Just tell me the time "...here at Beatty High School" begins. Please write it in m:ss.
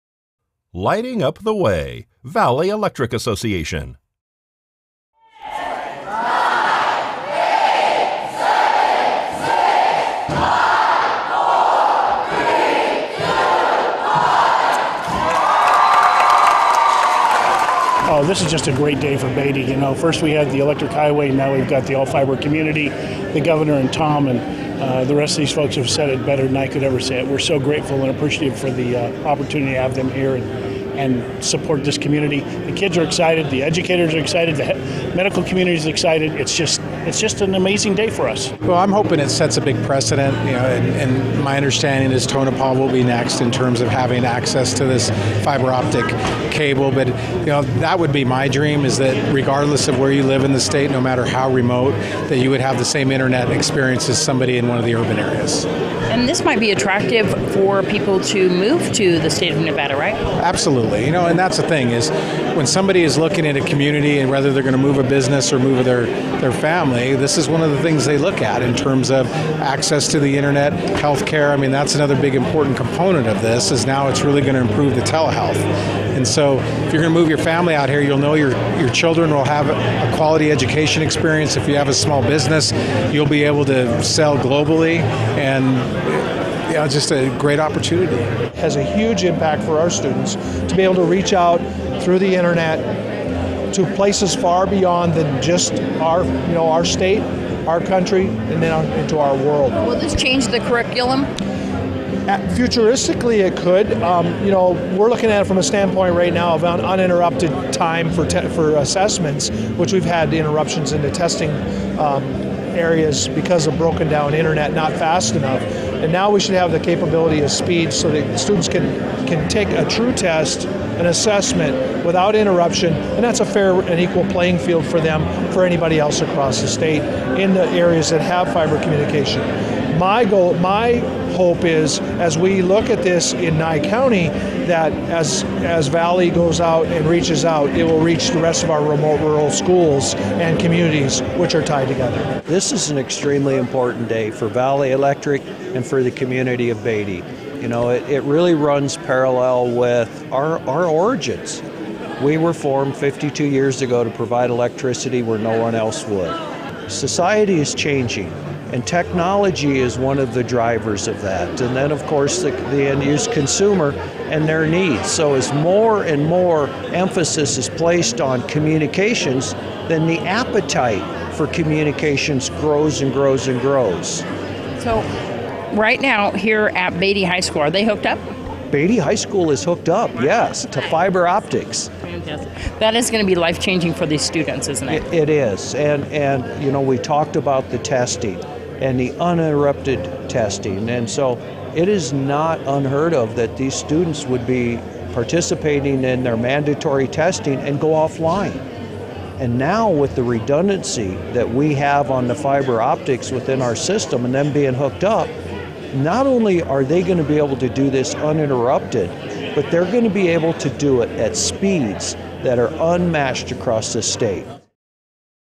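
2:56.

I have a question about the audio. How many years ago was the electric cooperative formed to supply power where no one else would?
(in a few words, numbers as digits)
52.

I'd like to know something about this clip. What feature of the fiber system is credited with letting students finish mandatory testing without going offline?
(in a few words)
redundancy.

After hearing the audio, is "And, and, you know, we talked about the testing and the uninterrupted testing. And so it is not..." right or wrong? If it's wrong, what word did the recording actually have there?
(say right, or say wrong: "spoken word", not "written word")
right.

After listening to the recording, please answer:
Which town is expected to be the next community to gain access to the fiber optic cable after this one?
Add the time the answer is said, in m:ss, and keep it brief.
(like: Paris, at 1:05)
Tonopah, at 0:42.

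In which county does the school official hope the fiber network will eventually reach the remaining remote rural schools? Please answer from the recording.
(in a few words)
Nye County.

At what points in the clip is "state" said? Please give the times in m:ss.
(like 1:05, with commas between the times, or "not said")
0:50, 0:59, 1:36, 2:06, 3:34.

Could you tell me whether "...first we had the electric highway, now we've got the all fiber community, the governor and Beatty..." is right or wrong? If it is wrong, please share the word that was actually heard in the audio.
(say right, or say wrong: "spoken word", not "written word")
wrong: "Tom", not "Beatty".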